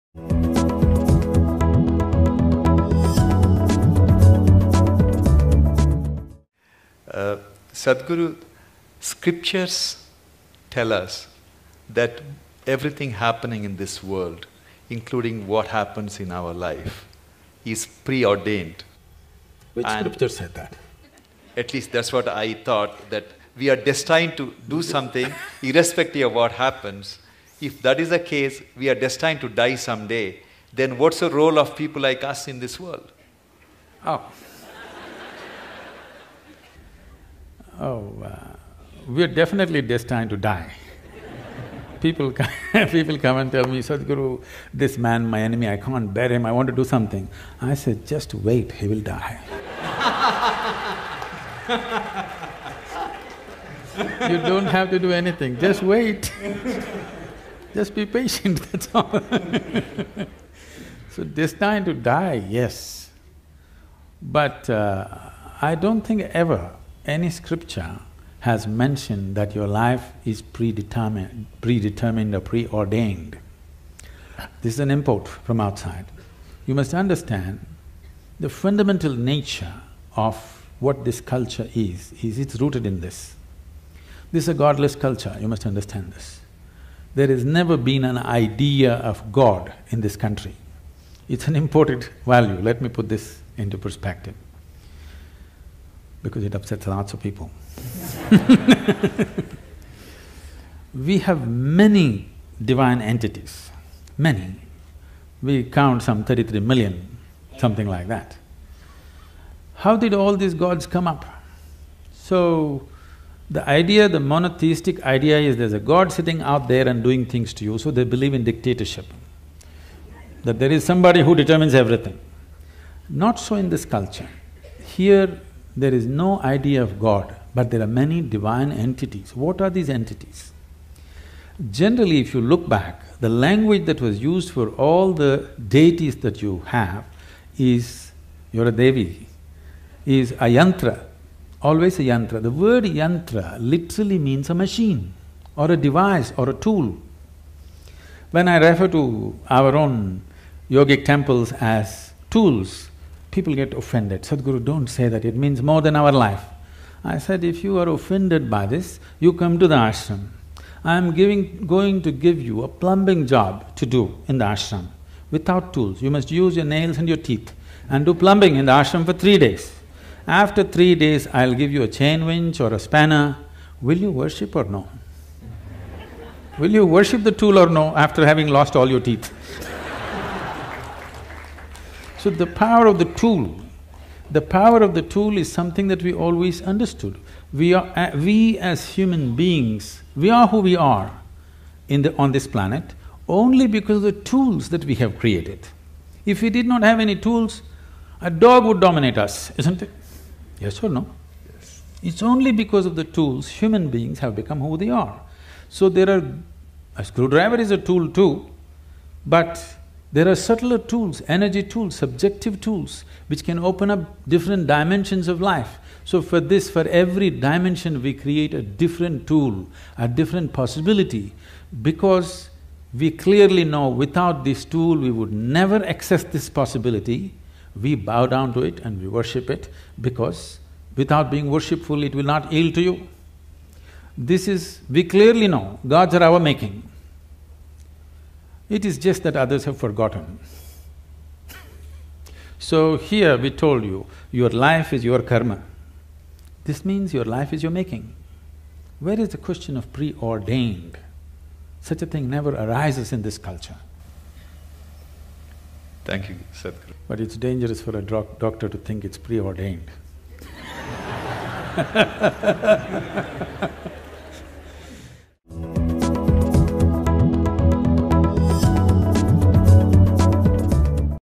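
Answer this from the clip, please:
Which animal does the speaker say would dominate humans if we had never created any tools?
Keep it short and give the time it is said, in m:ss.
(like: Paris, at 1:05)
a dog, at 3:18.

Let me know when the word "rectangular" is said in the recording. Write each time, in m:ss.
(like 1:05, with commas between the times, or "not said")
not said.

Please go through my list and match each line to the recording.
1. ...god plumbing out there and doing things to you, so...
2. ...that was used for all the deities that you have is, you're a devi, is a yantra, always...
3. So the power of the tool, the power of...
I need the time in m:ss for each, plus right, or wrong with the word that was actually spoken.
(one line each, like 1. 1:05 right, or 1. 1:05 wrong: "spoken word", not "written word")
1. 1:55 wrong: "sitting", not "plumbing"
2. 2:13 right
3. 3:02 right.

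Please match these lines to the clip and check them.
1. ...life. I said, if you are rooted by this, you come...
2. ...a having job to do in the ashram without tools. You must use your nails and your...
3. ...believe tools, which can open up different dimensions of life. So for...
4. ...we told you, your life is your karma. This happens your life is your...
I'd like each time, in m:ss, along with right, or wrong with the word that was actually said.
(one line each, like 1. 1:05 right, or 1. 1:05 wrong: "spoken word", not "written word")
1. 2:36 wrong: "offended", not "rooted"
2. 2:42 wrong: "plumbing", not "having"
3. 3:31 wrong: "subjective", not "believe"
4. 4:03 wrong: "means", not "happens".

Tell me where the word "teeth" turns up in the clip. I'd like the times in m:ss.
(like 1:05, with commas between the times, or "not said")
2:47, 2:58.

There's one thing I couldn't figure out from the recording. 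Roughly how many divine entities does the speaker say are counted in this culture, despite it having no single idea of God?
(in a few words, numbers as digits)
33 million.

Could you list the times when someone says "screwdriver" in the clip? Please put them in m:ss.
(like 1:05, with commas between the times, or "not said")
3:27.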